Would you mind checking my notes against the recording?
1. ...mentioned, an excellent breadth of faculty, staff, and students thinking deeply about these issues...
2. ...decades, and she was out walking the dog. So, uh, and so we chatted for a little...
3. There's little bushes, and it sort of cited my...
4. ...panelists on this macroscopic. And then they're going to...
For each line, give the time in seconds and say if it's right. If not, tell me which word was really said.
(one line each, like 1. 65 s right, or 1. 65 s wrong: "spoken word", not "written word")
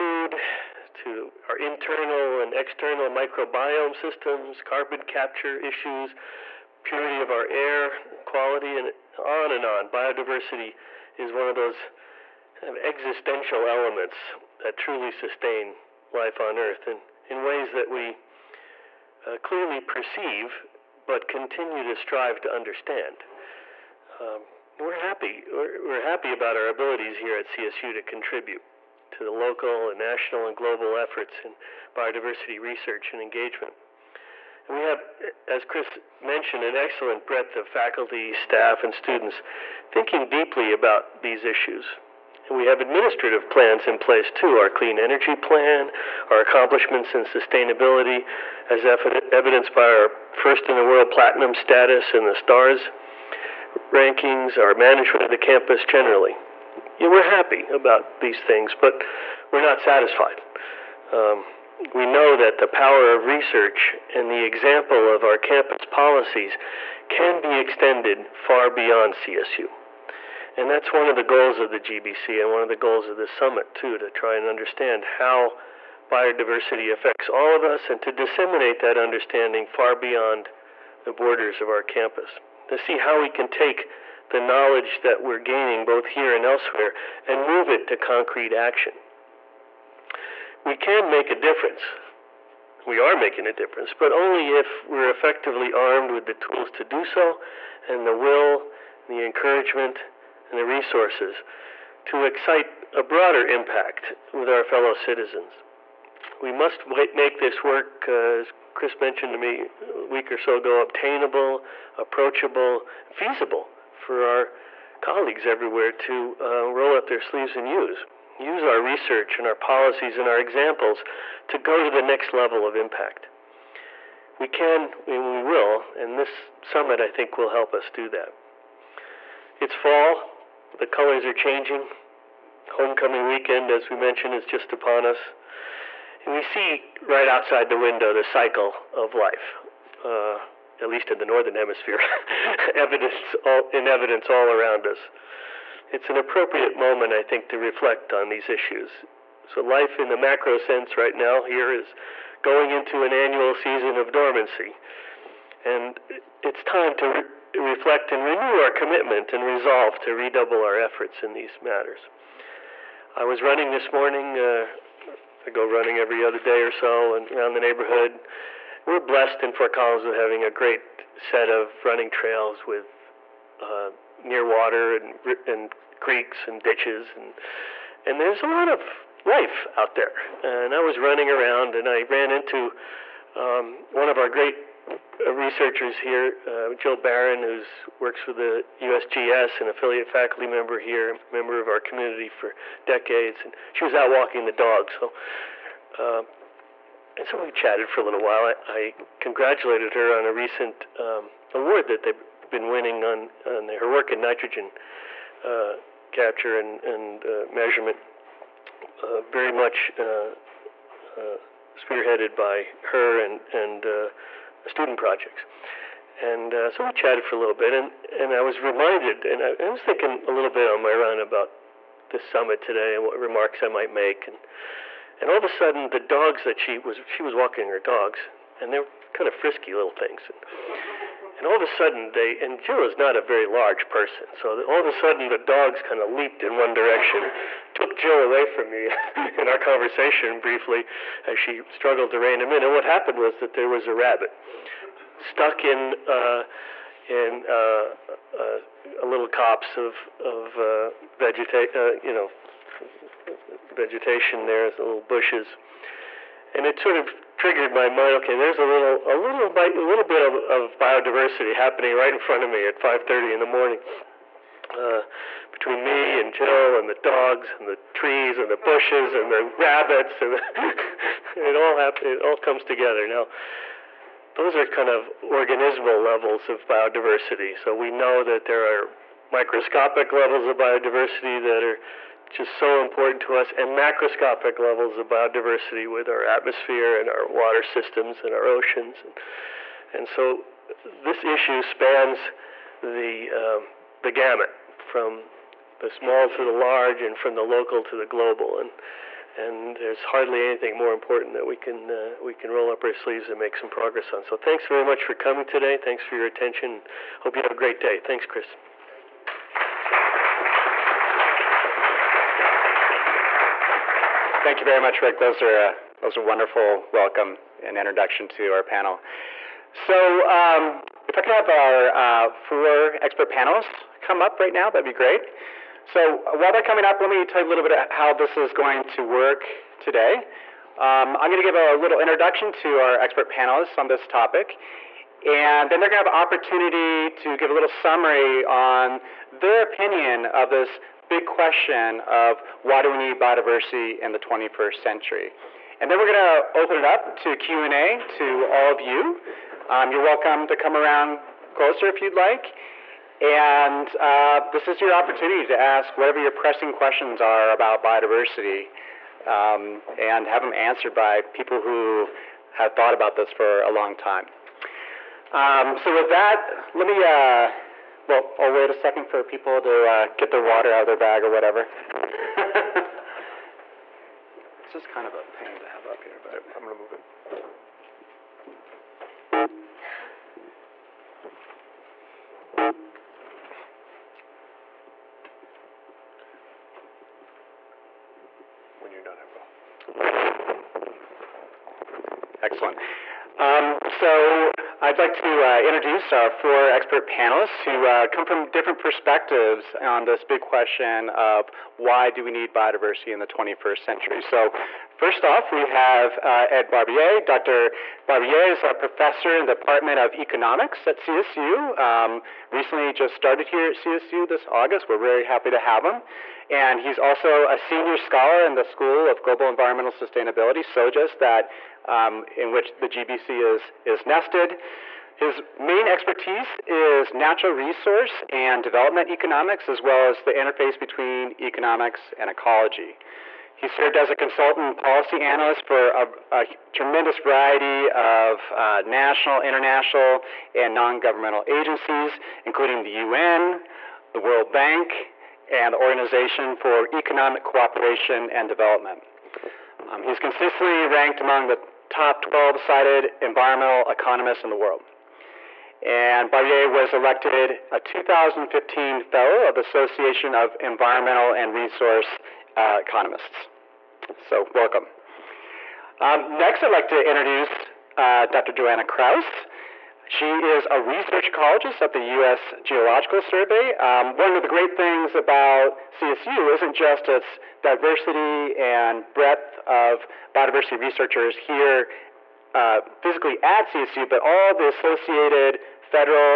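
1. 36 s right
2. 192 s right
3. 254 s wrong: "triggered", not "cited"
4. 333 s wrong: "topic", not "macroscopic".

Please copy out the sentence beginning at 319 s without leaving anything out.
So um, if I could have our uh, four expert panelists come up right now, that'd be great.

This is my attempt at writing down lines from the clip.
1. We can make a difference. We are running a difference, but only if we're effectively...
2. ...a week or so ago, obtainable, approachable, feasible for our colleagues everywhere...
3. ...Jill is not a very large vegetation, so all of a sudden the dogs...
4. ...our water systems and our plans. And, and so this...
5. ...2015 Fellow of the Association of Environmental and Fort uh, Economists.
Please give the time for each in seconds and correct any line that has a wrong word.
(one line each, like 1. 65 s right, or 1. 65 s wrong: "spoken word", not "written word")
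1. 90 s wrong: "making", not "running"
2. 109 s right
3. 232 s wrong: "person", not "vegetation"
4. 287 s wrong: "oceans", not "plans"
5. 457 s wrong: "Resource", not "Fort".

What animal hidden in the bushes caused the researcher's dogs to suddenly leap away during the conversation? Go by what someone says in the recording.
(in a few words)
Rabbit.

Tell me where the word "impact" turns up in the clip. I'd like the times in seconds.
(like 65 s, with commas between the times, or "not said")
103 s, 122 s.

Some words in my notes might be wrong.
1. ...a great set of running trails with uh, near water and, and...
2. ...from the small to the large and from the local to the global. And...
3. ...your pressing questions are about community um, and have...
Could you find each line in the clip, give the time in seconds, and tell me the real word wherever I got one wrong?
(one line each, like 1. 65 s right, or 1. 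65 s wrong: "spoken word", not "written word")
1. 170 s right
2. 294 s right
3. 356 s wrong: "biodiversity", not "community".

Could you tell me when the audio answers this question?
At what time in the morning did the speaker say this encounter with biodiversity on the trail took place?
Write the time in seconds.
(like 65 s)
262 s.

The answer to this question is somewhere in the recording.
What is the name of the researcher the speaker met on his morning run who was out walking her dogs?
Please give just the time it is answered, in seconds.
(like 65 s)
186 s.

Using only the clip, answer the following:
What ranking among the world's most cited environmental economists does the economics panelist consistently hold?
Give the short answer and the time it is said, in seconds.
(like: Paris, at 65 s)
12, at 452 s.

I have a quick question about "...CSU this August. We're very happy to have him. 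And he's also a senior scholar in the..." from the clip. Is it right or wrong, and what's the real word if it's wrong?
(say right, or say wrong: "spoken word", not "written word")
right.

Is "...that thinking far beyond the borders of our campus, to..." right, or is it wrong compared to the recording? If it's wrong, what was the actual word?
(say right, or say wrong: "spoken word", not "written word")
wrong: "understanding", not "thinking".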